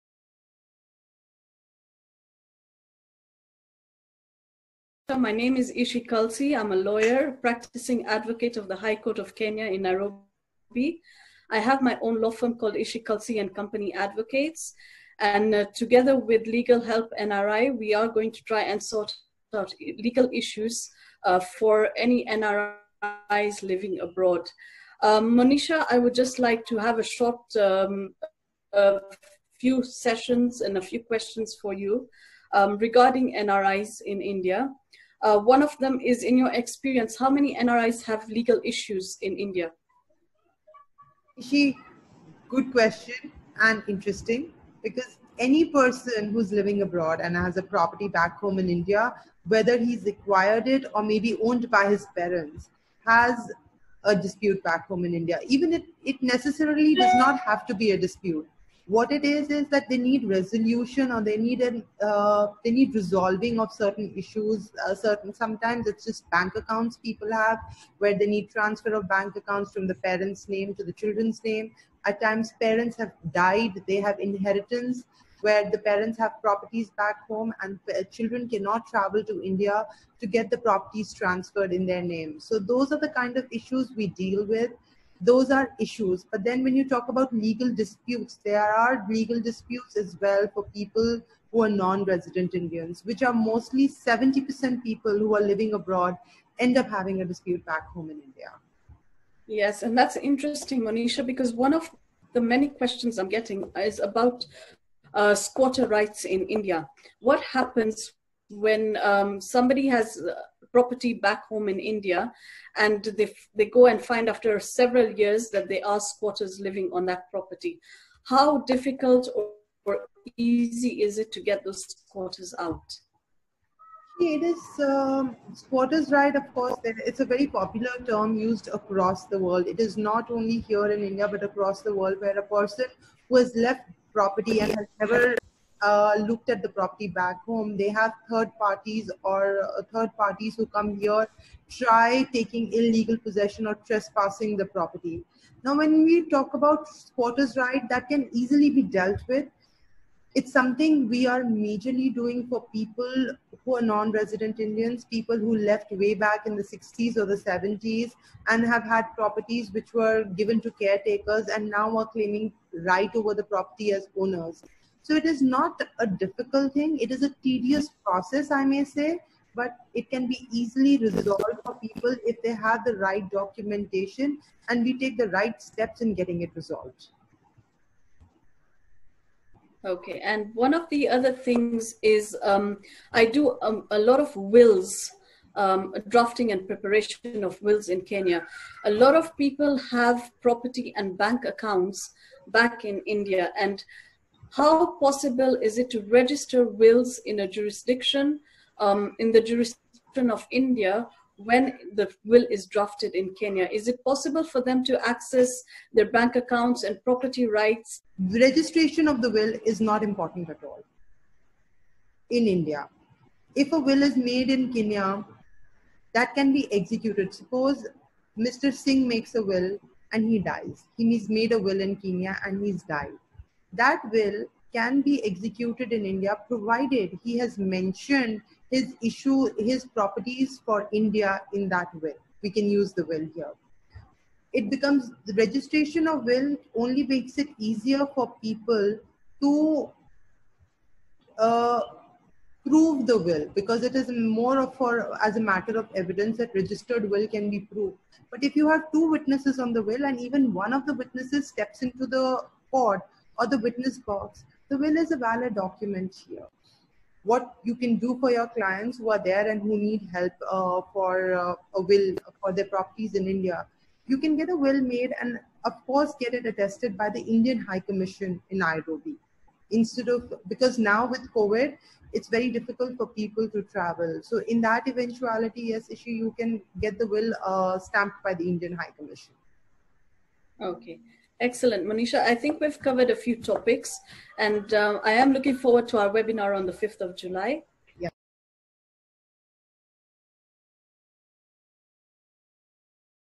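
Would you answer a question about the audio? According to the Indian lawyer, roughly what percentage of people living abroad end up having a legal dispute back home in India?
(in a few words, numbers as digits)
70%.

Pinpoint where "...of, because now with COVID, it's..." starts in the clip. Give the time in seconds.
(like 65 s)
270 s.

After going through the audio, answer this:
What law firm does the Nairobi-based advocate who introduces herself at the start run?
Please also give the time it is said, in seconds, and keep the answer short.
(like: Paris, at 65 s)
Ishi Kalsi and Company Advocates, at 12 s.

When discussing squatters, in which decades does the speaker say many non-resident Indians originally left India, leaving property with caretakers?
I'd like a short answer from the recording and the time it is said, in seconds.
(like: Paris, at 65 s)
the 60s or the 70s, at 156 s.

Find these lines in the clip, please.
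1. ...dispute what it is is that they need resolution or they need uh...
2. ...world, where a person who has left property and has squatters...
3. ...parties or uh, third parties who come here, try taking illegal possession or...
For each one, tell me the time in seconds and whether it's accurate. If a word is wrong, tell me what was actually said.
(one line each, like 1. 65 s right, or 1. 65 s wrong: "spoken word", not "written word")
1. 57 s right
2. 131 s wrong: "never", not "squatters"
3. 138 s right.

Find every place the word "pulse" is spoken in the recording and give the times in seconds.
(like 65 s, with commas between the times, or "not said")
not said.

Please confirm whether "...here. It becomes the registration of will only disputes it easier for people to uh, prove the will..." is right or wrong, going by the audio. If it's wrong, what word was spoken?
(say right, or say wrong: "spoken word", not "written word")
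wrong: "makes", not "disputes".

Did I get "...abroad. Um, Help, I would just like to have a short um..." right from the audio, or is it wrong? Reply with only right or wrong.
wrong.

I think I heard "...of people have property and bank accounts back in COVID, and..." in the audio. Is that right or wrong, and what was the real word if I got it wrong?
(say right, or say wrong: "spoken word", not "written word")
wrong: "India", not "COVID".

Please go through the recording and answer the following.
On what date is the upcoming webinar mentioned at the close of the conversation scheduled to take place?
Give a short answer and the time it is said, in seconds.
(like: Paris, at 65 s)
5th of July, at 286 s.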